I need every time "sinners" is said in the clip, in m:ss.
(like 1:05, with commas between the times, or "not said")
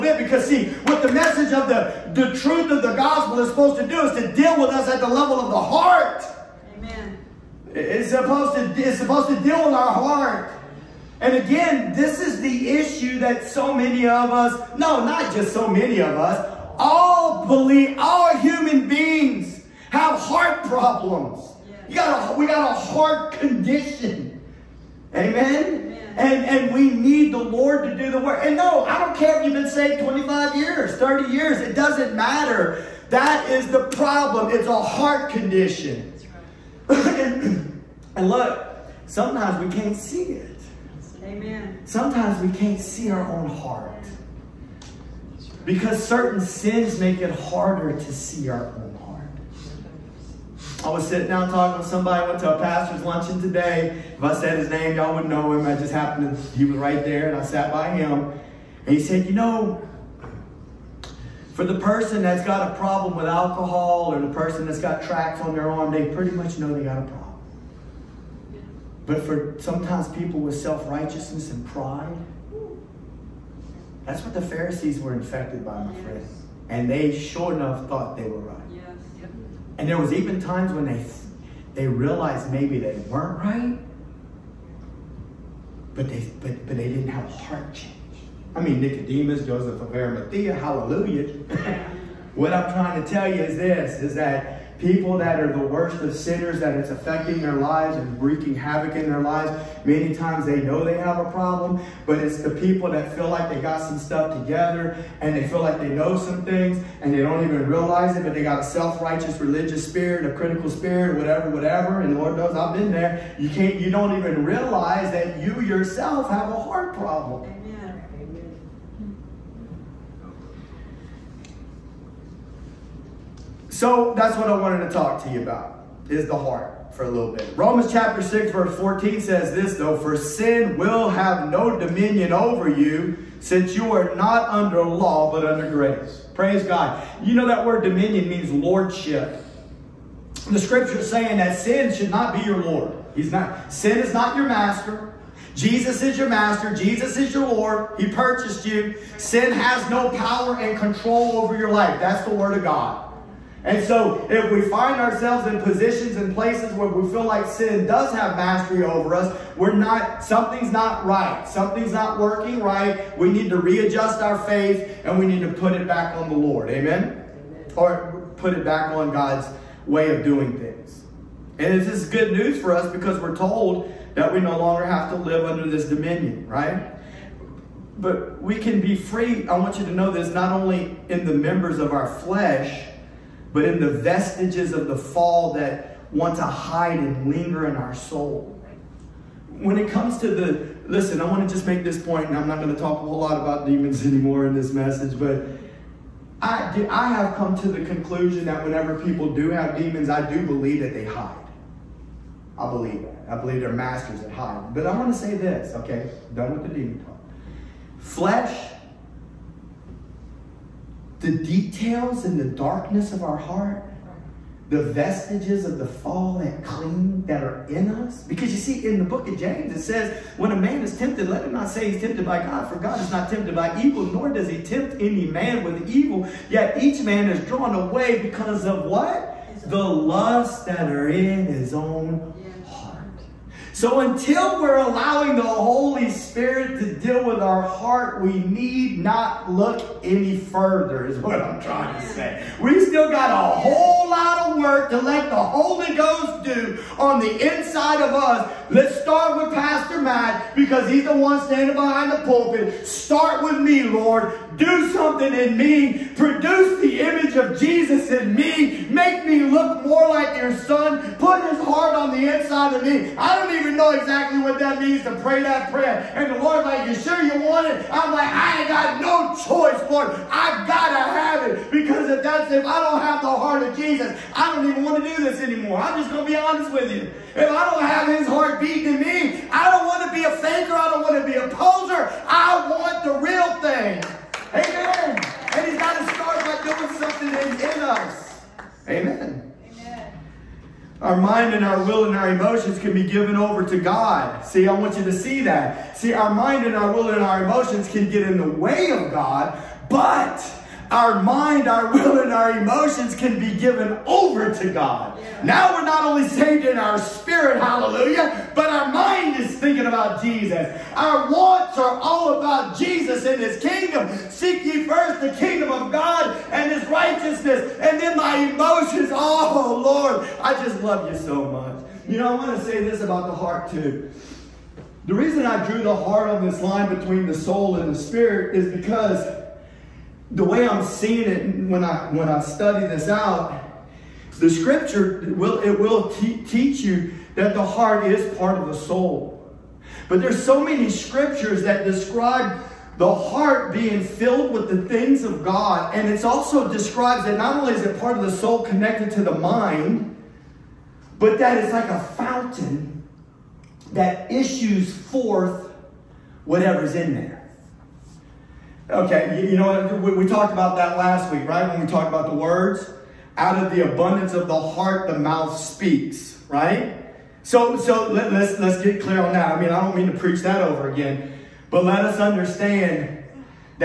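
1:36.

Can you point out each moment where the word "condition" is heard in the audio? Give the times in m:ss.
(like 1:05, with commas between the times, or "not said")
0:23, 0:35.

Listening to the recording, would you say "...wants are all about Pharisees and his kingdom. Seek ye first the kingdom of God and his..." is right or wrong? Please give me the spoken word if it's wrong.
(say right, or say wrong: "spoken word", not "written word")
wrong: "Jesus", not "Pharisees".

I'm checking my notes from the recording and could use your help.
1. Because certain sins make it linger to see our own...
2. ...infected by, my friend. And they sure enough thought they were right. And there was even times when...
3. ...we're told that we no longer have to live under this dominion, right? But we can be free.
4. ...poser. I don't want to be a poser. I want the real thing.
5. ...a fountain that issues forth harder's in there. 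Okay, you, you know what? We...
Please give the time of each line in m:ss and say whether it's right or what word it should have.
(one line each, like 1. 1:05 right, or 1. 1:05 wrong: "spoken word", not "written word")
1. 0:45 wrong: "harder", not "linger"
2. 1:15 right
3. 2:53 right
4. 4:40 wrong: "faker", not "poser"
5. 5:51 wrong: "whatever", not "harder".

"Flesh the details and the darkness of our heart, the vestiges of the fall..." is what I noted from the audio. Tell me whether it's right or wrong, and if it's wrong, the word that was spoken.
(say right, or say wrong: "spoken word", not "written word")
right.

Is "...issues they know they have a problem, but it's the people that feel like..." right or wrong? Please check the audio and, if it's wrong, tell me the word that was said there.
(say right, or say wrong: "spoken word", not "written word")
wrong: "times", not "issues".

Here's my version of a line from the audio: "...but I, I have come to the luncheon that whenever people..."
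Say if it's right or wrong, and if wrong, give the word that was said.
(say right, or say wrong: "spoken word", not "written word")
wrong: "conclusion", not "luncheon".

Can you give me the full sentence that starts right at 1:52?
And Lord knows I've been there.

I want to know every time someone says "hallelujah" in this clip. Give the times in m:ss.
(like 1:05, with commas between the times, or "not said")
1:30, 5:07.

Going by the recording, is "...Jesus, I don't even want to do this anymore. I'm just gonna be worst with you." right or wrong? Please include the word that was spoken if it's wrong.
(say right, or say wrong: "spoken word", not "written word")
wrong: "honest", not "worst".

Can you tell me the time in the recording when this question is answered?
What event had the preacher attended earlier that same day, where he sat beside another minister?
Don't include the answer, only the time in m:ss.
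0:52.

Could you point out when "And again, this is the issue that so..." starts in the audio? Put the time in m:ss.
0:11.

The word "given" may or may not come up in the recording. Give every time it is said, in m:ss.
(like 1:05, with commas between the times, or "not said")
4:53, 5:03.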